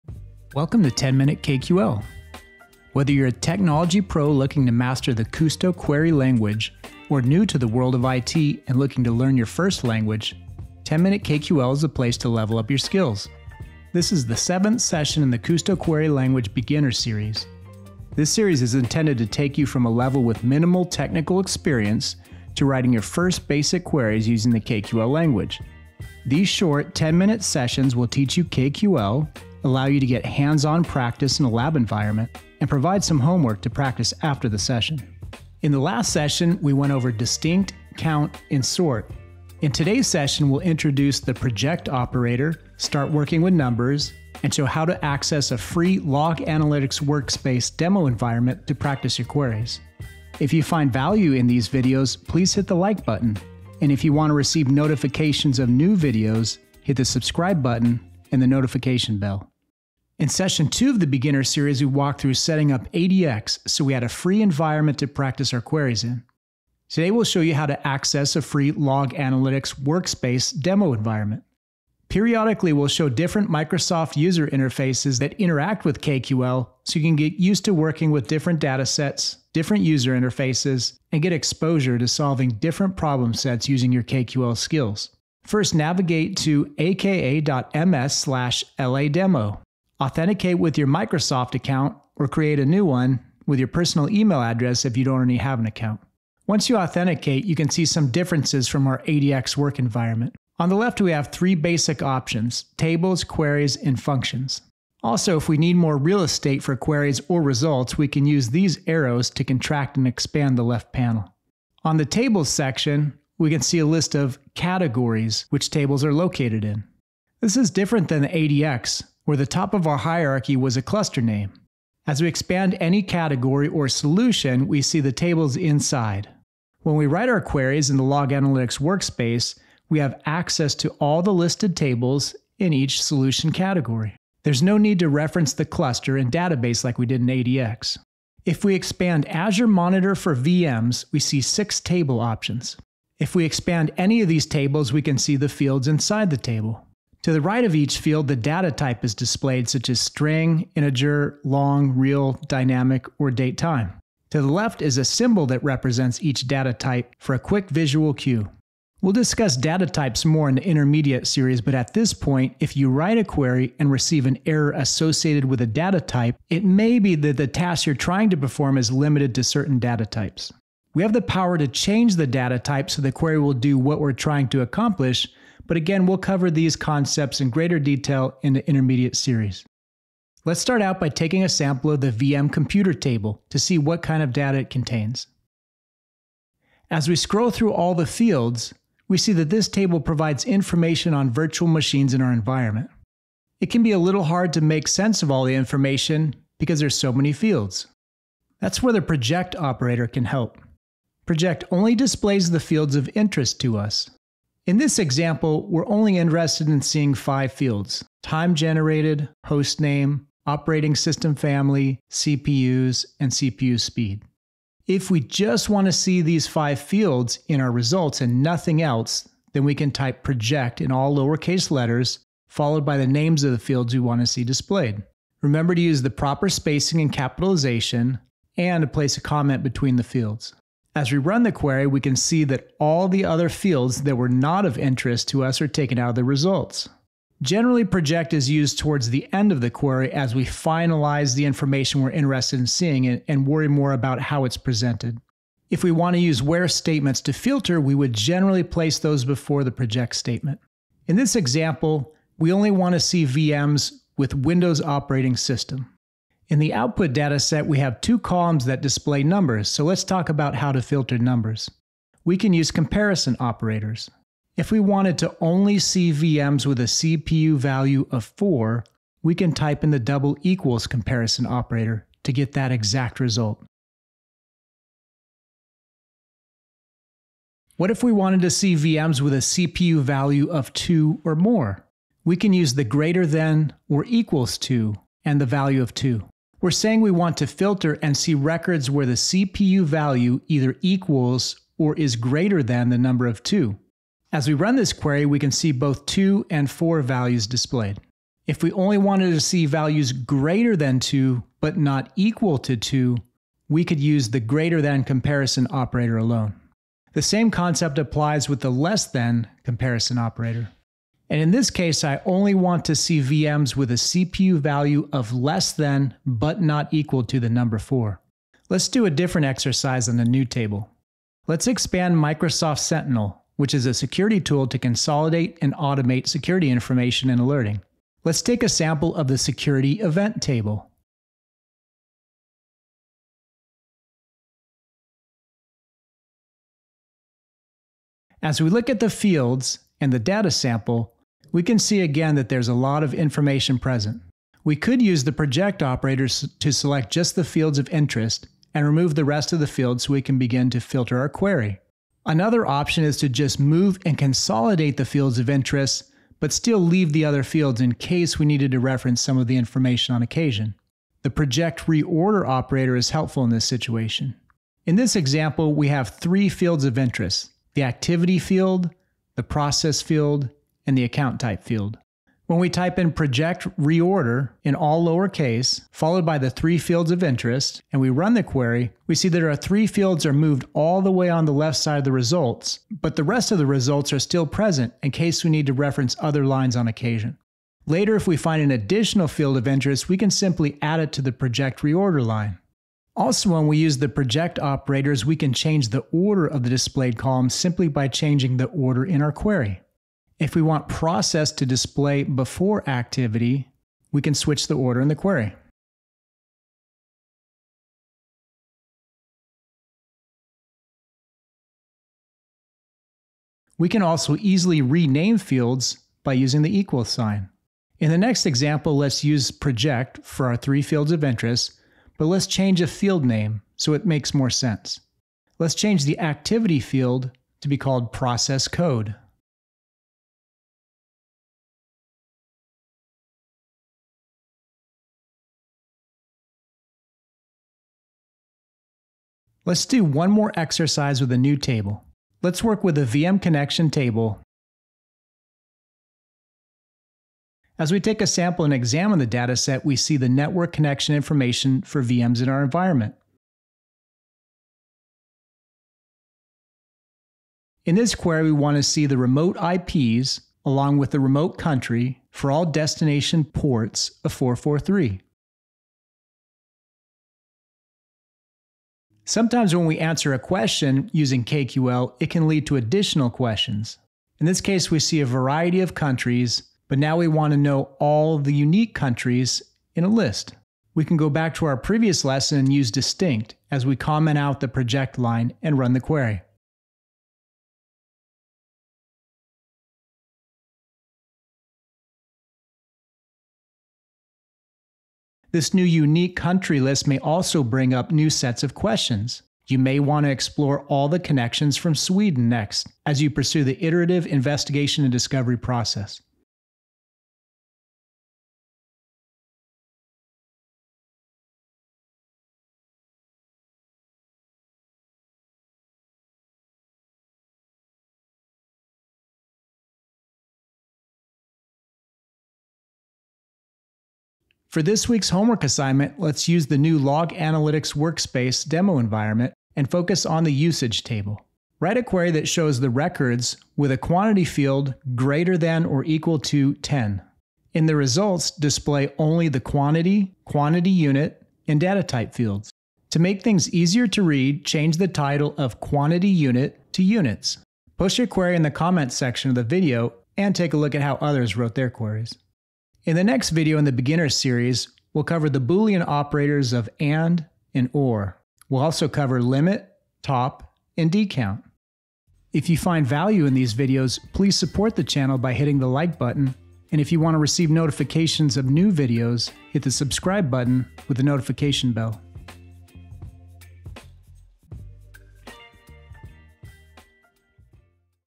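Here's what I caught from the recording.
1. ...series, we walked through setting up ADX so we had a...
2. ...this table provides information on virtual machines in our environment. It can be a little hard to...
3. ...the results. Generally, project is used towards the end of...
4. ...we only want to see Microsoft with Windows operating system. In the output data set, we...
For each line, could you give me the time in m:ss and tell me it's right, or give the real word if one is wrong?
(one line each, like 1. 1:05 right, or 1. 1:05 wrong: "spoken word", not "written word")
1. 1:01 right
2. 3:09 right
3. 3:56 right
4. 4:12 wrong: "VMs", not "Microsoft".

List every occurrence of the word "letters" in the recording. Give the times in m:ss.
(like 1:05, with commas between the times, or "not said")
3:41.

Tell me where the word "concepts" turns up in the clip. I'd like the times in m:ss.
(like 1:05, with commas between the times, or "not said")
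2:56, 5:07.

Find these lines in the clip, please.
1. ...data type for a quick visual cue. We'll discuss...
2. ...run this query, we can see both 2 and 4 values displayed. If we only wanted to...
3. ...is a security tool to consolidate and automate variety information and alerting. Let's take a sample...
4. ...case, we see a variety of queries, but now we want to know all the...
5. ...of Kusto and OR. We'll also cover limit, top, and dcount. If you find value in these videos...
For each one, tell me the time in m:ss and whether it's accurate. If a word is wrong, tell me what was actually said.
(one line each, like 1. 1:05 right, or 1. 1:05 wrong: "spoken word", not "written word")
1. 2:36 right
2. 4:54 right
3. 5:23 wrong: "security", not "variety"
4. 7:54 wrong: "countries", not "queries"
5. 9:16 wrong: "AND", not "Kusto".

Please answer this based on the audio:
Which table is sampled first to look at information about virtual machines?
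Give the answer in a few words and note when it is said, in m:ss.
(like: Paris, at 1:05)
VM computer, at 3:02.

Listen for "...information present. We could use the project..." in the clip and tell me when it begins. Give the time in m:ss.
5:43.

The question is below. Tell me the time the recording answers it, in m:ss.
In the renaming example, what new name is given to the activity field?
7:08.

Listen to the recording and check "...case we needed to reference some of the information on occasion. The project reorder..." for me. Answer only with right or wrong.
right.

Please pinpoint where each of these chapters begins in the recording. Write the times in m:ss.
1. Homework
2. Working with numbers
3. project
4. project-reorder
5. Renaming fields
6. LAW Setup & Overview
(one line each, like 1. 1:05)
1. 8:44
2. 4:25
3. 3:02
4. 5:21
5. 7:05
6. 1:00.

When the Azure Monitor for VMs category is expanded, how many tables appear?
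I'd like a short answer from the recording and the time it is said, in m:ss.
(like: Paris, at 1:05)
6, at 2:21.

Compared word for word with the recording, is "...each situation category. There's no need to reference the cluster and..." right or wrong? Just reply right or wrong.
wrong.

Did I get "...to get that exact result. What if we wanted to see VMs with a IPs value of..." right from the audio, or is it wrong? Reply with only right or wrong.
wrong.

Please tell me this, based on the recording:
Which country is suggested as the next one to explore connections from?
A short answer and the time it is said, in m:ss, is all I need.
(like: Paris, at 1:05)
Sweden, at 8:21.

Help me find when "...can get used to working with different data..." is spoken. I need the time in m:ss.
1:17.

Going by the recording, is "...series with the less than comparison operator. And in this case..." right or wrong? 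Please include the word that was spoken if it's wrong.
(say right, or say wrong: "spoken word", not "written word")
wrong: "applies", not "series".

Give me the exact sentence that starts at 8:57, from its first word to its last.
In the results, display only the quantity, quantity unit, and data type fields.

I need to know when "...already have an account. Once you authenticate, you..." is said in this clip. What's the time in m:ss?
1:35.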